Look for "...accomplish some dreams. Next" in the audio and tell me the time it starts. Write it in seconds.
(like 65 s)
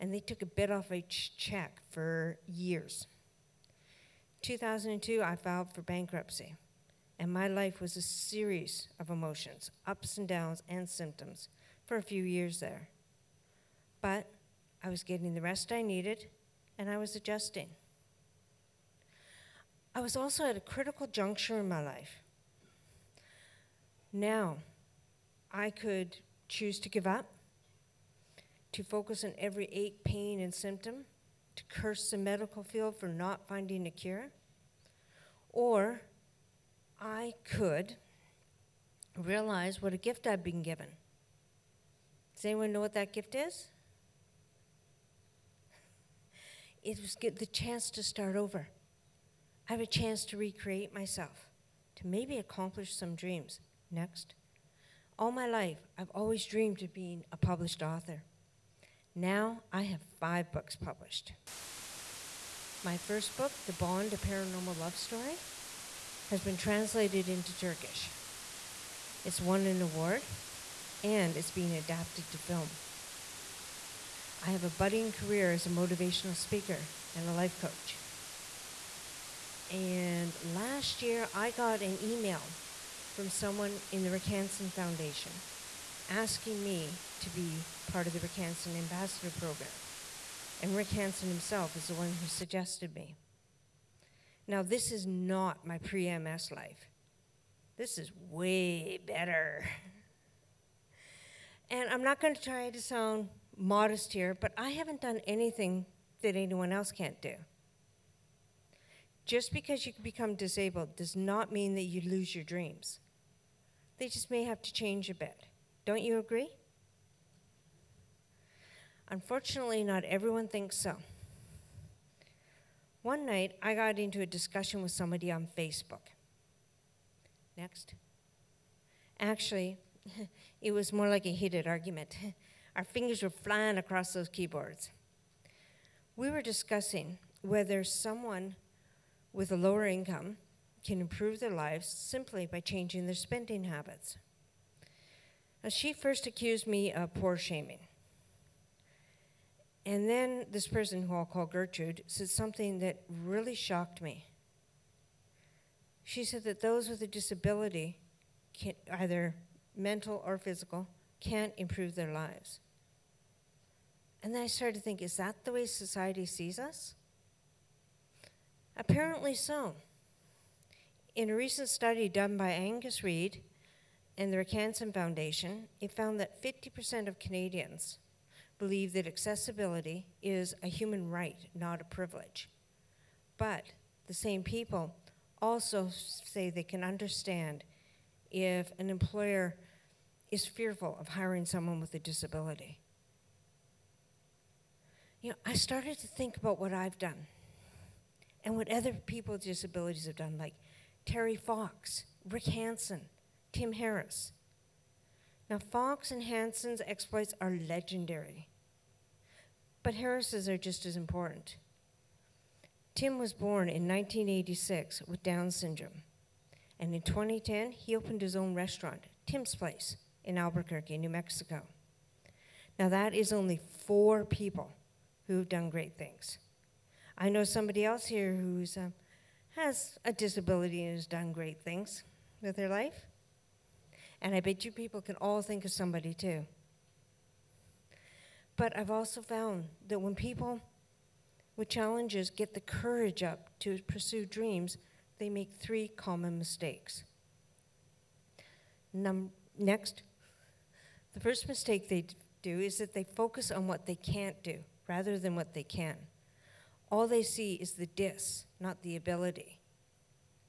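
52 s.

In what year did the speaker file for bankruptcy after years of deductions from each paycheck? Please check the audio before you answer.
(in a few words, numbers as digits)
2002.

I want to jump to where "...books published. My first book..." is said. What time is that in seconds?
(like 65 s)
60 s.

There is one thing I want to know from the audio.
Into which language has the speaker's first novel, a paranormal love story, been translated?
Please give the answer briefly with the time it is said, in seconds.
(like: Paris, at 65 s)
Turkish, at 67 s.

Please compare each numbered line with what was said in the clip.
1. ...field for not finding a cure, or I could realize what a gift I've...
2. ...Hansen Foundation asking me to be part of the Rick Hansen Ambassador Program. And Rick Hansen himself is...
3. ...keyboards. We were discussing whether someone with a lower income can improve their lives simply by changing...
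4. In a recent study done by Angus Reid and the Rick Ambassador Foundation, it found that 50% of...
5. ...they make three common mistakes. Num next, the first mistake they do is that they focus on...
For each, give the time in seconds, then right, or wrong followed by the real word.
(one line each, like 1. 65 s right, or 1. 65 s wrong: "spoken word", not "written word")
1. 32 s right
2. 84 s right
3. 134 s right
4. 171 s wrong: "Hansen", not "Ambassador"
5. 245 s right.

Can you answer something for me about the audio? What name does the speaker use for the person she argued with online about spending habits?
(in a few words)
Gertrude.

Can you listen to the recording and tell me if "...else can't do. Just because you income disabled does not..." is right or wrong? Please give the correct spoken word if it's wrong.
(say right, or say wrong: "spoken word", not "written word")
wrong: "become", not "income".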